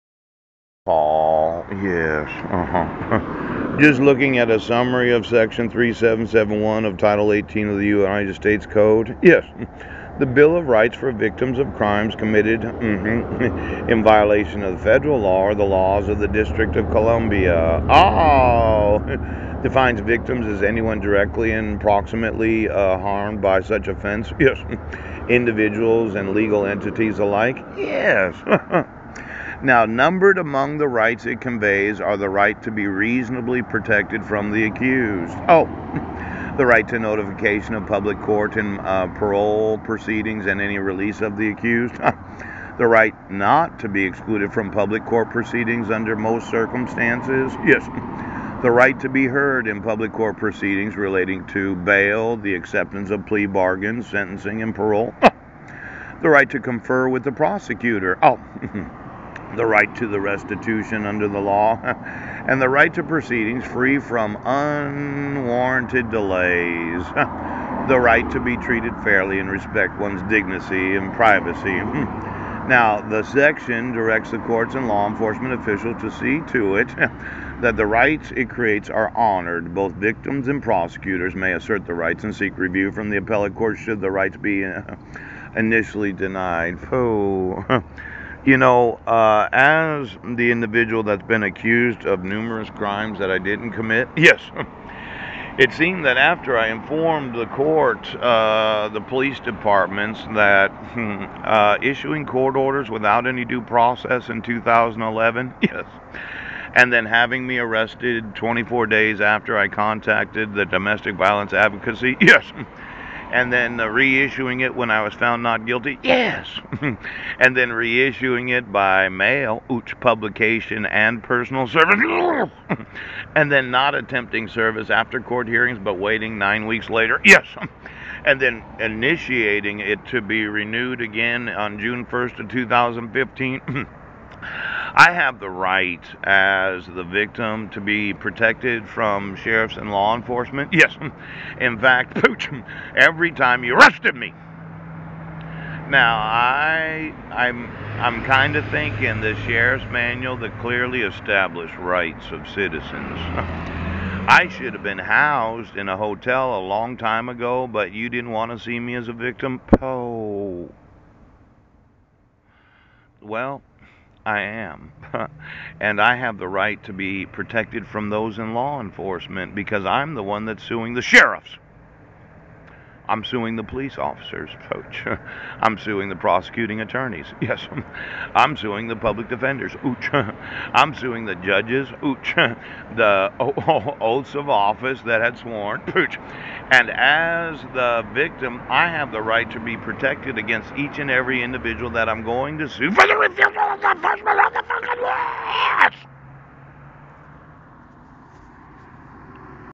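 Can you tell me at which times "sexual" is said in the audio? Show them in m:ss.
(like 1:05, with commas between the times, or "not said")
not said.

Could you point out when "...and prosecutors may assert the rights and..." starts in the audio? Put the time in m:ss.
1:20.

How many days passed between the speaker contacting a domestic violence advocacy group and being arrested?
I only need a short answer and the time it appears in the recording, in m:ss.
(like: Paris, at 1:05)
24, at 1:48.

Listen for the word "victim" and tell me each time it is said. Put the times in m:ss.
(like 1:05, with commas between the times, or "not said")
0:11, 0:19, 1:19, 2:17, 2:39, 3:08.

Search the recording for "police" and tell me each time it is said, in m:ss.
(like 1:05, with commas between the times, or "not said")
1:39, 2:53.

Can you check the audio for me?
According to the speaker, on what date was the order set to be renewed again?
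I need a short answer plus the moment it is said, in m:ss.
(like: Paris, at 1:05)
June 1, 2015, at 2:11.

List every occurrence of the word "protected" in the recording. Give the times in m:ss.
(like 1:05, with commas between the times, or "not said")
0:33, 2:18, 2:47, 3:09.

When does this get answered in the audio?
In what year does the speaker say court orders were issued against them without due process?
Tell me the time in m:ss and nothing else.
1:44.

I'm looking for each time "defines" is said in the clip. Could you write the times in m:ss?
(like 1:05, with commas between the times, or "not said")
0:19.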